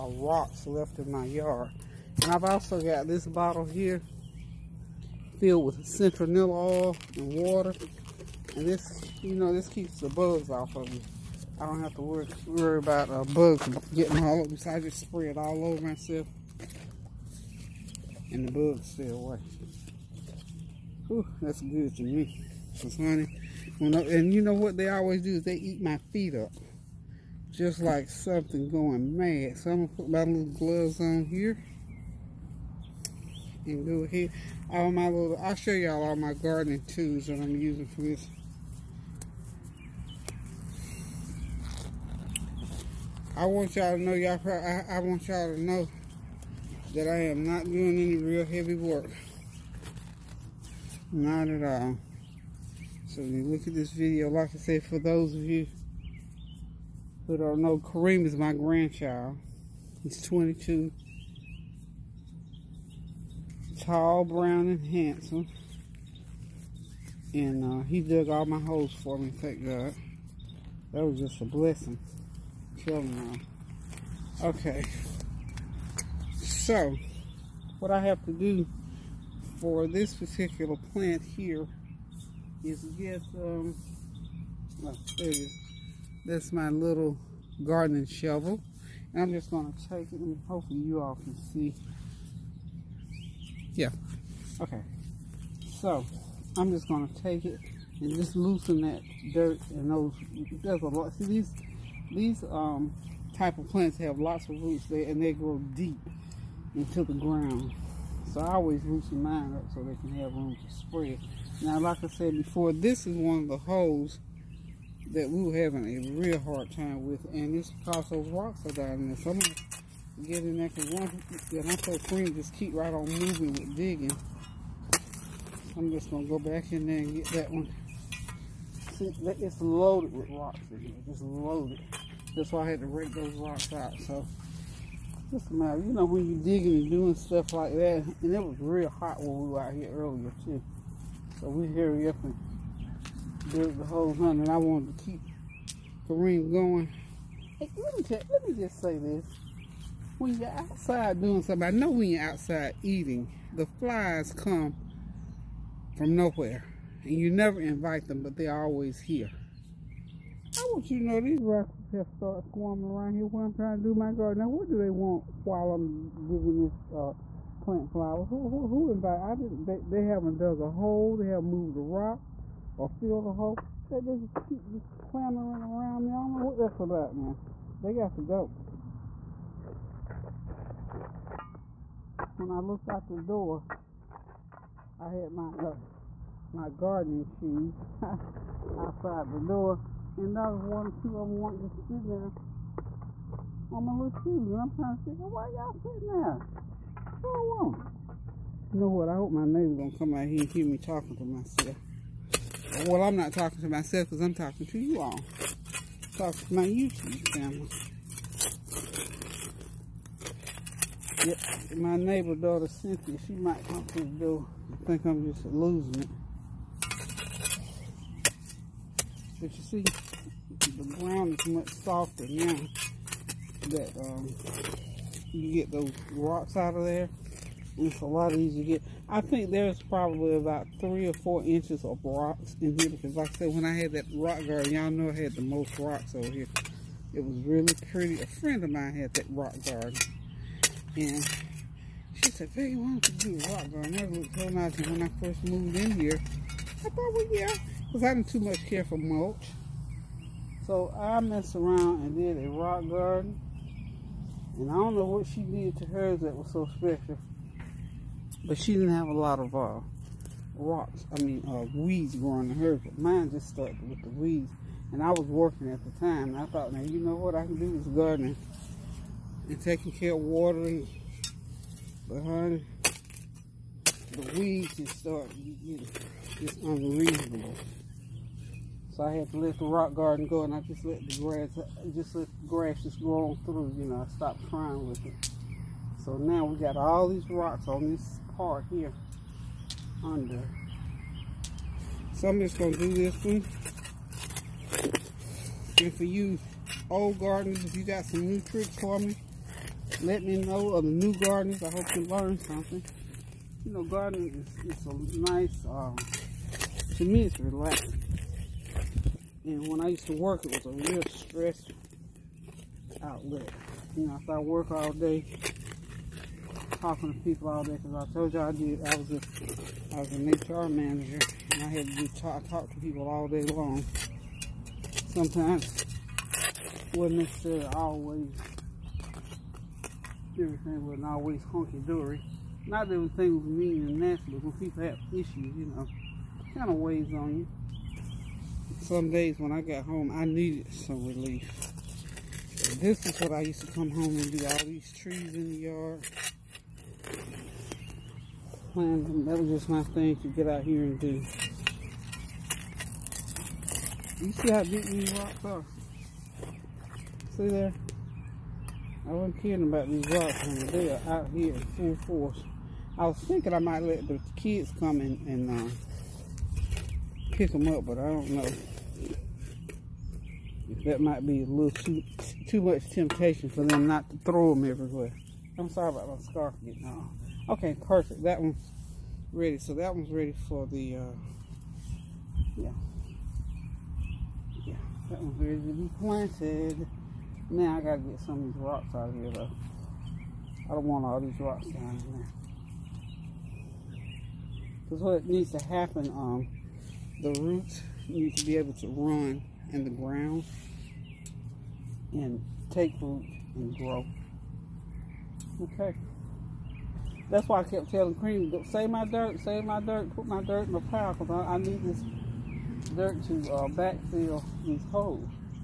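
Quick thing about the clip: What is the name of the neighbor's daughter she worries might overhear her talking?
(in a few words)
Cynthia.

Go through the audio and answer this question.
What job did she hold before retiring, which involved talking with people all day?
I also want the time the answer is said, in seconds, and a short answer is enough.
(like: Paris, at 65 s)
HR manager, at 320 s.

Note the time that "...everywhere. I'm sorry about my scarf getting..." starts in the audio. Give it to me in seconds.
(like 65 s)
374 s.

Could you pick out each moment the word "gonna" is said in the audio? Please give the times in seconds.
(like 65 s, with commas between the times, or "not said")
119 s, 126 s, 292 s.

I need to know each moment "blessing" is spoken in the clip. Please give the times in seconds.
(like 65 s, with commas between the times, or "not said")
71 s.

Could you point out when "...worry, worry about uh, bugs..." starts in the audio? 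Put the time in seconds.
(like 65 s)
12 s.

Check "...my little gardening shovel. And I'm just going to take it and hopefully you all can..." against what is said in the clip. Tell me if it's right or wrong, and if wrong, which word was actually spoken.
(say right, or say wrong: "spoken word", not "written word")
right.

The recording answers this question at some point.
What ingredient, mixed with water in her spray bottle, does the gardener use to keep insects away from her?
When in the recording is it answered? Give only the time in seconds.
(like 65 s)
5 s.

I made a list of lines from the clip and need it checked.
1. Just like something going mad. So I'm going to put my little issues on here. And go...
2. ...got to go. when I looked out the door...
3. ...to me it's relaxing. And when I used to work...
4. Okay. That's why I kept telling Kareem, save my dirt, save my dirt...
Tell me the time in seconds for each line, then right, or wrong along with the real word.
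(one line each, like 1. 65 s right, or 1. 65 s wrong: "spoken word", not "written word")
1. 27 s wrong: "gloves", not "issues"
2. 177 s right
3. 306 s right
4. 405 s right.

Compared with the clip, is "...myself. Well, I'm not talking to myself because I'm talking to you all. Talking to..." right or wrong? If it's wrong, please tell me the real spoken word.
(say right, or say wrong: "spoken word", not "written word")
right.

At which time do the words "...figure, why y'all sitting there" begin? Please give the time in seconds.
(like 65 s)
195 s.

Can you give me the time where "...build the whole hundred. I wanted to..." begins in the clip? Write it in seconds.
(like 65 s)
143 s.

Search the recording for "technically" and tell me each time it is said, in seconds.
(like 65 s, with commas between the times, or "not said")
not said.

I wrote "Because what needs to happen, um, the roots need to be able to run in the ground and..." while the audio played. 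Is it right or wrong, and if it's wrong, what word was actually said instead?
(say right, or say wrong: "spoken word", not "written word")
right.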